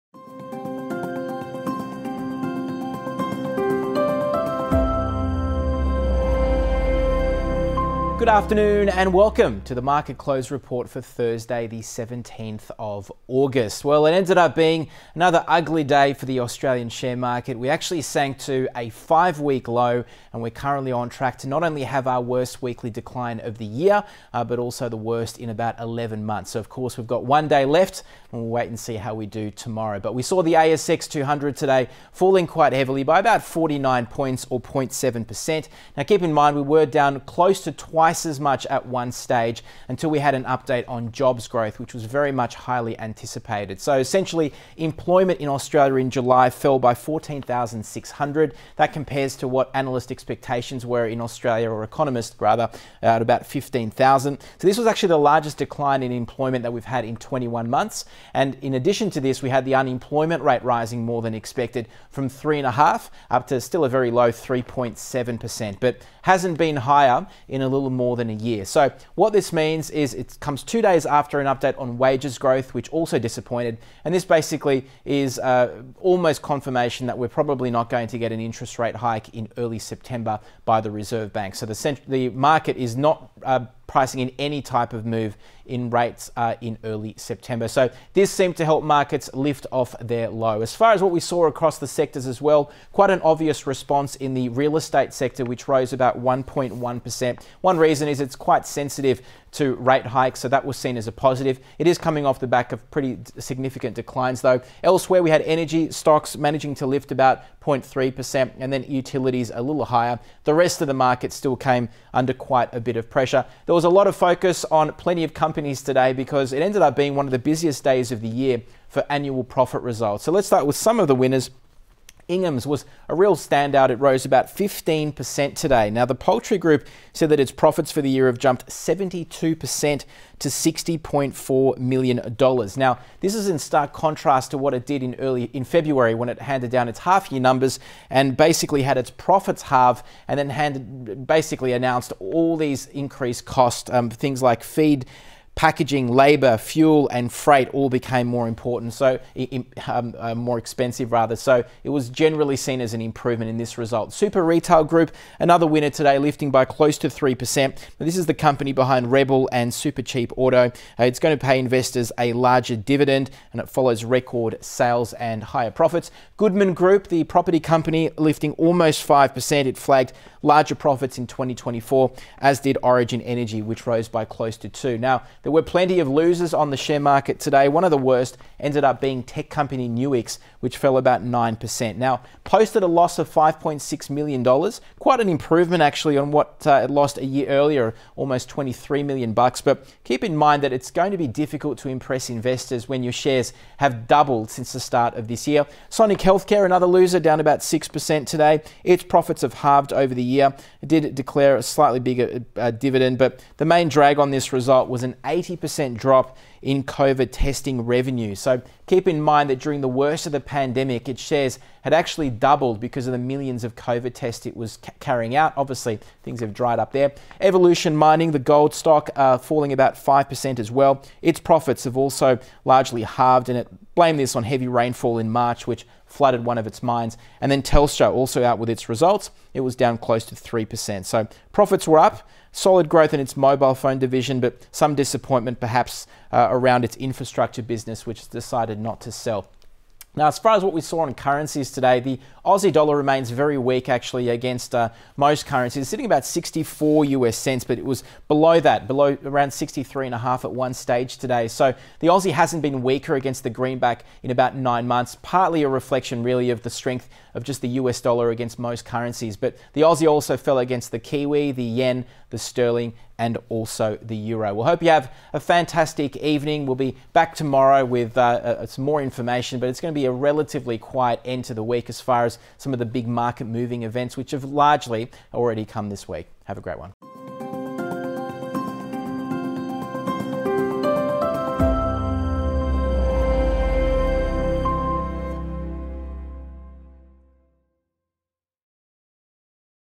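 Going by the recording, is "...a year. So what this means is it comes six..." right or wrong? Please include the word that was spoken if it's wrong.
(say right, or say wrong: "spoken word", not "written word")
wrong: "two", not "six".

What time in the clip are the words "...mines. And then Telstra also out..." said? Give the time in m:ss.
3:46.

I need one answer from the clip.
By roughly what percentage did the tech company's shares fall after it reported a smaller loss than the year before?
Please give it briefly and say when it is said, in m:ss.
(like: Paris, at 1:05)
9%, at 3:01.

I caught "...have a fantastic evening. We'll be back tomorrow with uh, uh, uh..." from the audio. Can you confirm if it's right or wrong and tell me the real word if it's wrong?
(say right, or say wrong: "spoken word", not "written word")
right.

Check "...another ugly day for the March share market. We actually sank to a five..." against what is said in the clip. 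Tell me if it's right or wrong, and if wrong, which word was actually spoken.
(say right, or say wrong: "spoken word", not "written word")
wrong: "Australian", not "March".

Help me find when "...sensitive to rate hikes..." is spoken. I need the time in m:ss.
1:38.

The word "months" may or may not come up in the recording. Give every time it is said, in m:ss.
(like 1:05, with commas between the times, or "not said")
0:26, 0:57, 4:14.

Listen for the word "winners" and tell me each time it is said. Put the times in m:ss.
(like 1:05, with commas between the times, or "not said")
2:01, 2:35.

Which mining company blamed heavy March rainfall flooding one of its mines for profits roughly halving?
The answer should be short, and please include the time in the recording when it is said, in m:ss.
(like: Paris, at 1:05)
Evolution Mining, at 3:37.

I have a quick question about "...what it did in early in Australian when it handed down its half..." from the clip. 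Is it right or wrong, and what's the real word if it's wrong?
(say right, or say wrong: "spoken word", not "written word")
wrong: "February", not "Australian".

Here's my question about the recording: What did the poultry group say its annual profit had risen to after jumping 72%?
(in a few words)
$60.4 million.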